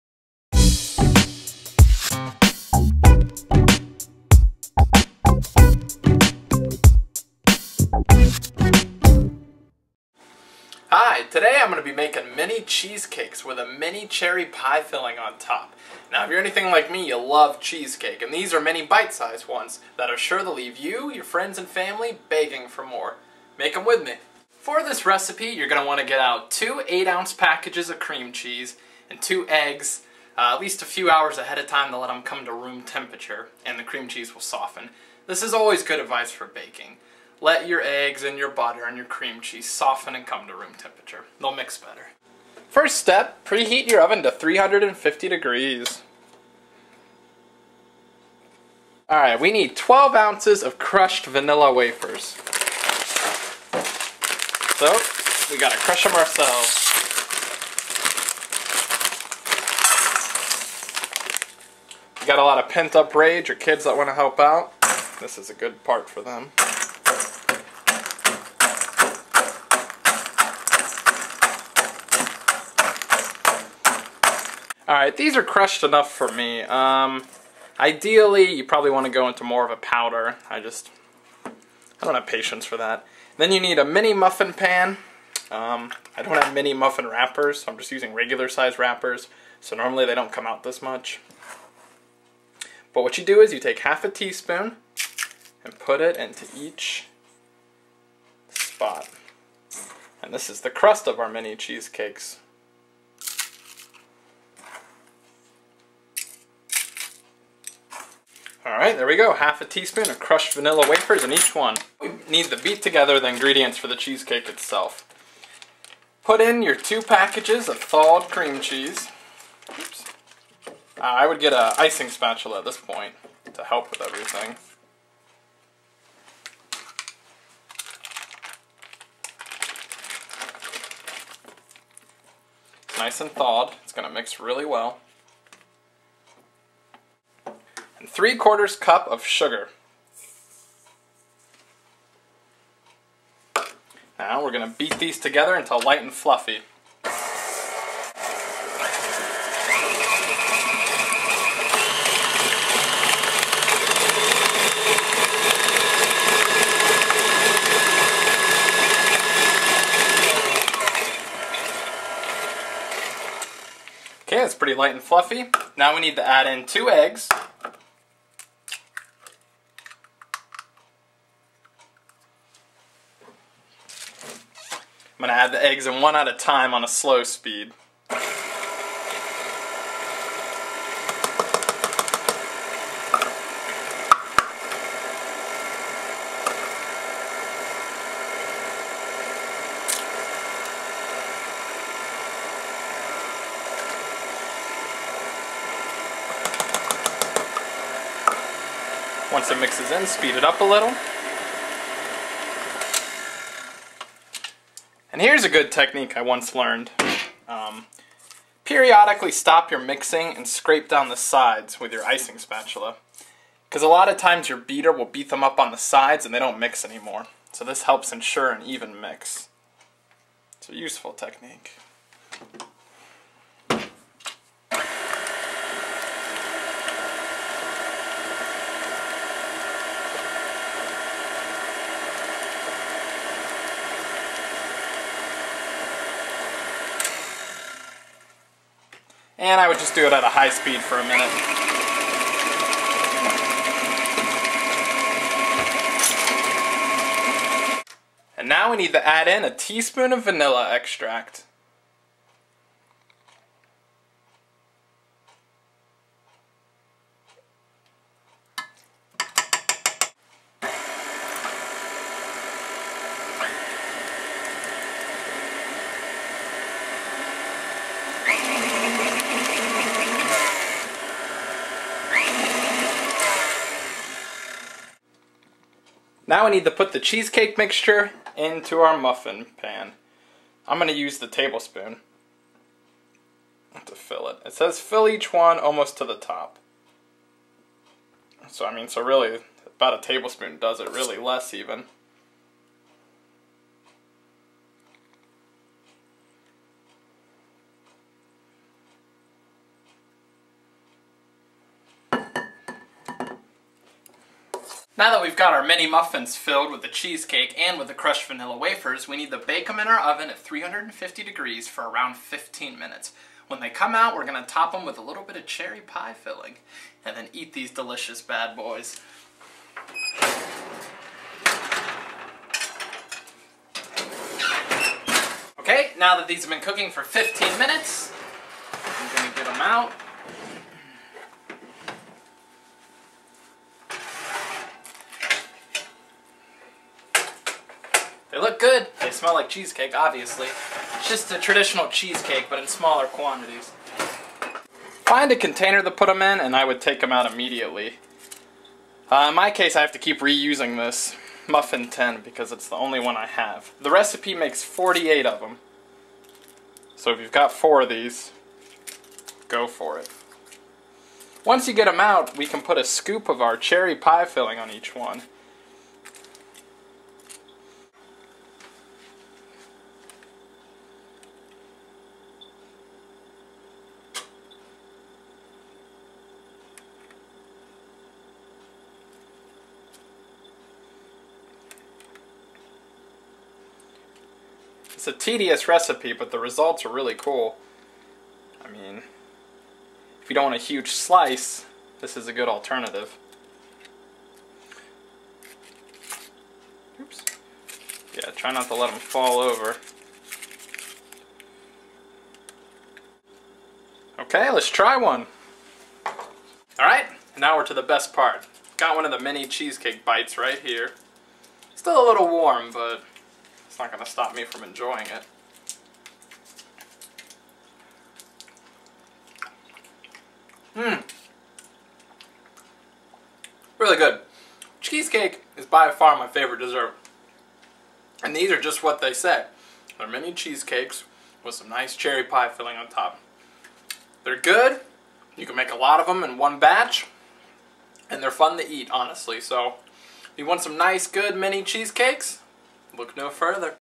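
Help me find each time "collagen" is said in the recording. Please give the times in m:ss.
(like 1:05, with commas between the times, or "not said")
not said.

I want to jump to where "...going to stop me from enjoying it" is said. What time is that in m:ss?
6:53.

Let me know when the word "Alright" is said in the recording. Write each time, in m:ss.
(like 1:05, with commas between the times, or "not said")
0:49, 1:14, 1:48.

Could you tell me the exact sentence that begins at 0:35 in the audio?
This is always good advice for baking.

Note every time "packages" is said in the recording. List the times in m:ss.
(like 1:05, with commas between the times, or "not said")
0:27, 1:57.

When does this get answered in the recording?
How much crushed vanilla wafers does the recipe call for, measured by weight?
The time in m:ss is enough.
0:49.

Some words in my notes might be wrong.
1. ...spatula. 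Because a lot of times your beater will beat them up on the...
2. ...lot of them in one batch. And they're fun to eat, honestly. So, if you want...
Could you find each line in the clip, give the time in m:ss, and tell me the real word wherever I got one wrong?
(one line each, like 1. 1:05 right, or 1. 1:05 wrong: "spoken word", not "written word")
1. 3:32 right
2. 7:15 right.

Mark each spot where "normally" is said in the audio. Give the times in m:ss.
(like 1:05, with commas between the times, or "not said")
1:29.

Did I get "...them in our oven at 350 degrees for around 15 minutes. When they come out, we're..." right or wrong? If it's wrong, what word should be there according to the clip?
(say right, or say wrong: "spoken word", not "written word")
right.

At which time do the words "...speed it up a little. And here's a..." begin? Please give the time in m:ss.
3:20.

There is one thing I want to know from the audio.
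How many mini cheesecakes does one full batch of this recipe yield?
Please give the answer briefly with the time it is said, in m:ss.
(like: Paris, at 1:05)
48, at 5:54.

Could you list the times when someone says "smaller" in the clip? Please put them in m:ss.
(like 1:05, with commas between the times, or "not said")
5:42.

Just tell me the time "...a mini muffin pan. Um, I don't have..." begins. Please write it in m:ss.
1:23.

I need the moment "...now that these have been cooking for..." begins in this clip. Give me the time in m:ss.
5:25.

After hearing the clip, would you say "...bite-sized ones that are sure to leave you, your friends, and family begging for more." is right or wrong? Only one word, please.
right.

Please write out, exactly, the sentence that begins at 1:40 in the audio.
And this is the crust of our mini cheesecakes.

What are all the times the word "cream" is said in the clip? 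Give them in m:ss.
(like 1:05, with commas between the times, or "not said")
0:27, 0:33, 0:39, 1:58.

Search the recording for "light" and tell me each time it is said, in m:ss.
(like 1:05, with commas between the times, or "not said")
2:25, 2:44.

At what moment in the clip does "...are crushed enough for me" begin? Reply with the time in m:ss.
1:15.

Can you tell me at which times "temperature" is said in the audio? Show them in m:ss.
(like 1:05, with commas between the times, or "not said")
0:32, 0:40.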